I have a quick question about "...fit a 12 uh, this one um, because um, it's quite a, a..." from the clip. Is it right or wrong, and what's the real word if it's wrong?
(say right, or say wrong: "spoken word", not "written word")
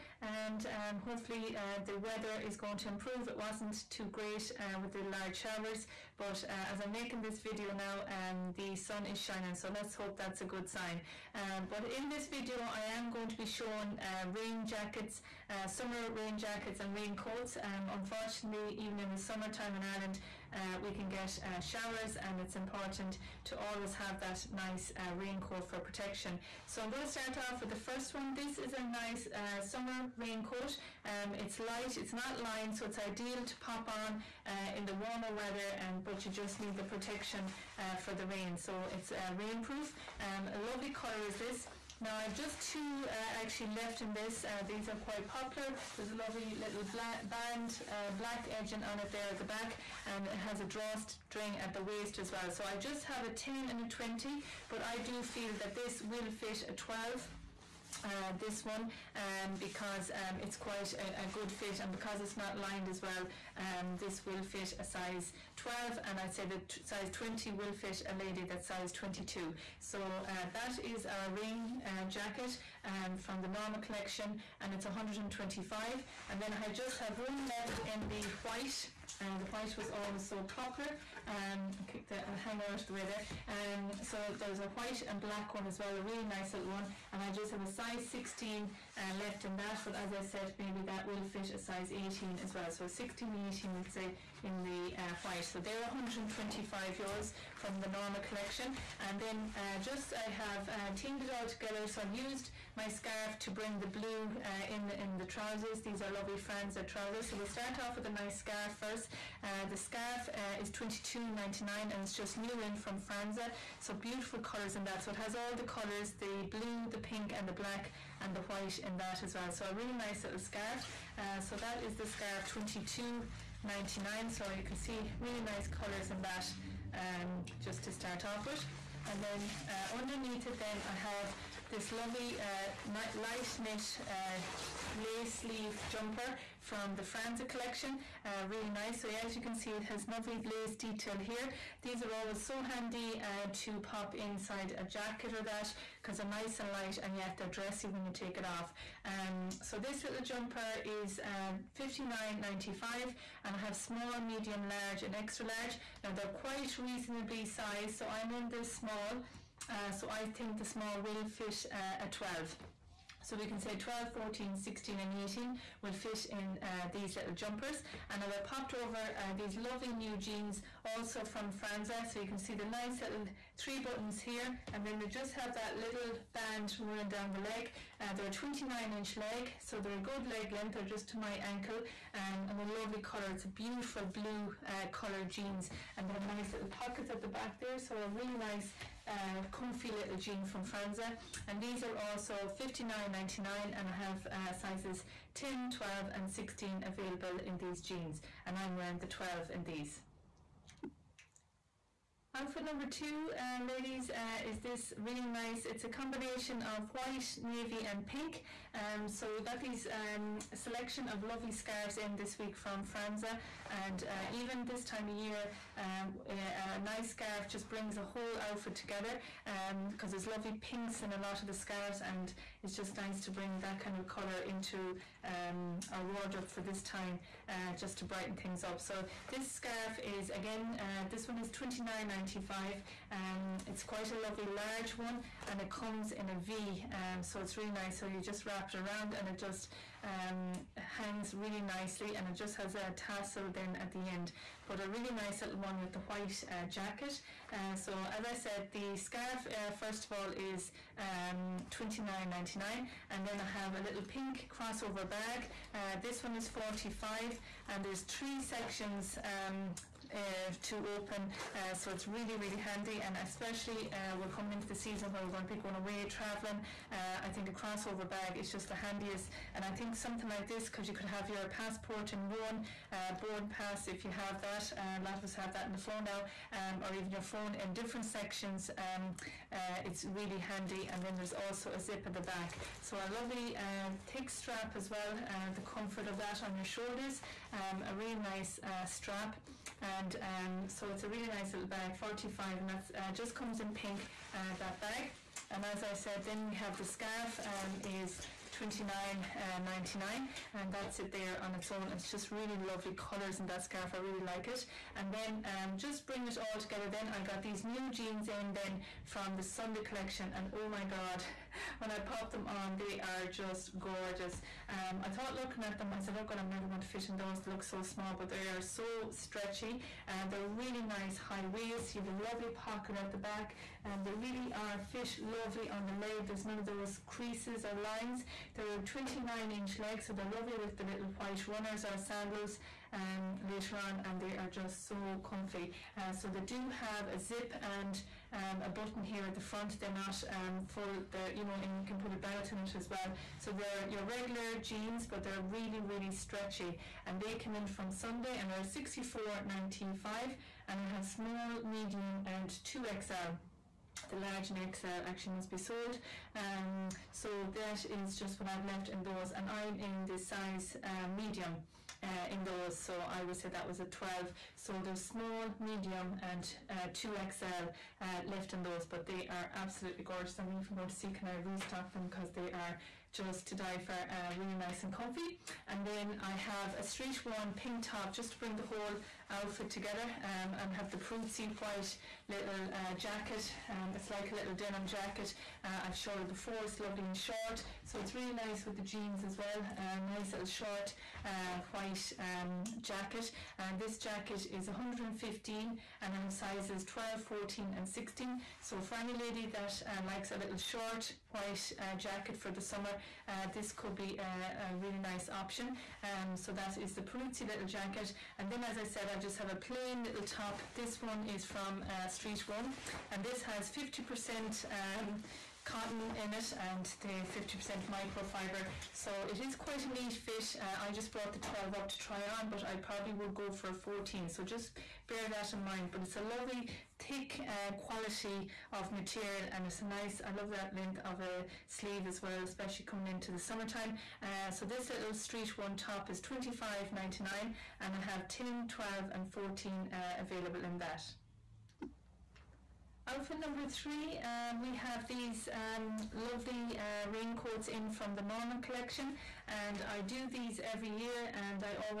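right.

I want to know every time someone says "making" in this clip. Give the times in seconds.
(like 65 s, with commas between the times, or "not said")
6 s.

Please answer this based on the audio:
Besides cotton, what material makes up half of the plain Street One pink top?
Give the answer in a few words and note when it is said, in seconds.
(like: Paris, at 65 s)
microfiber, at 417 s.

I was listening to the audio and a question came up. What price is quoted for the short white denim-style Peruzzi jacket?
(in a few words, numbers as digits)
115.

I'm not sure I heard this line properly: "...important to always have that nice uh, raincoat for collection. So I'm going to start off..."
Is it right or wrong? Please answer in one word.
wrong.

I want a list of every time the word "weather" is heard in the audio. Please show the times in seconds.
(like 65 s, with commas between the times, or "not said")
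1 s, 35 s.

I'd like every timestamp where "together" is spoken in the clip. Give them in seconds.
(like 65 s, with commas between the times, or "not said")
101 s, 218 s, 306 s, 379 s.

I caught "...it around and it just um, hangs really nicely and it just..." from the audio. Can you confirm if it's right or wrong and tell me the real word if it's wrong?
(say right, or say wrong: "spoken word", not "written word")
right.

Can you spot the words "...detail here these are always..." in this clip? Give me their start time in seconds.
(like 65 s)
140 s.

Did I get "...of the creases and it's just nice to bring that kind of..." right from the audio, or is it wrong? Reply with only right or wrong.
wrong.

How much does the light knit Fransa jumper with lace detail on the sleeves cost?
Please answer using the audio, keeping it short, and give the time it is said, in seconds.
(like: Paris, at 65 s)
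59.95, at 151 s.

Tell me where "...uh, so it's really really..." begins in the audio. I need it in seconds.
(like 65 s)
261 s.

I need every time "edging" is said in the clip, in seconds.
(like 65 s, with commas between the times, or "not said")
48 s.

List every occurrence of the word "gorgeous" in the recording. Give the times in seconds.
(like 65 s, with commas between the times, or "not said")
313 s, 370 s.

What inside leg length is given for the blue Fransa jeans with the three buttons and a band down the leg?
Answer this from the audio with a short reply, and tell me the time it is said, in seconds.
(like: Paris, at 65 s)
29 inch, at 178 s.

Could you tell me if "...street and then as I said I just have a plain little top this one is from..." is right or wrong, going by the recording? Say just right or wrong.
wrong.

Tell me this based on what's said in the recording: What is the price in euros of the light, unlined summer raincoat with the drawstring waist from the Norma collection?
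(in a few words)
125.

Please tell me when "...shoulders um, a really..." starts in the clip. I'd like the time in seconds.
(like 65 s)
286 s.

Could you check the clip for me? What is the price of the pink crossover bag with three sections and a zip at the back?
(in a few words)
45.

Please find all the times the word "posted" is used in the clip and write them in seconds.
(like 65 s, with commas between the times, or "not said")
not said.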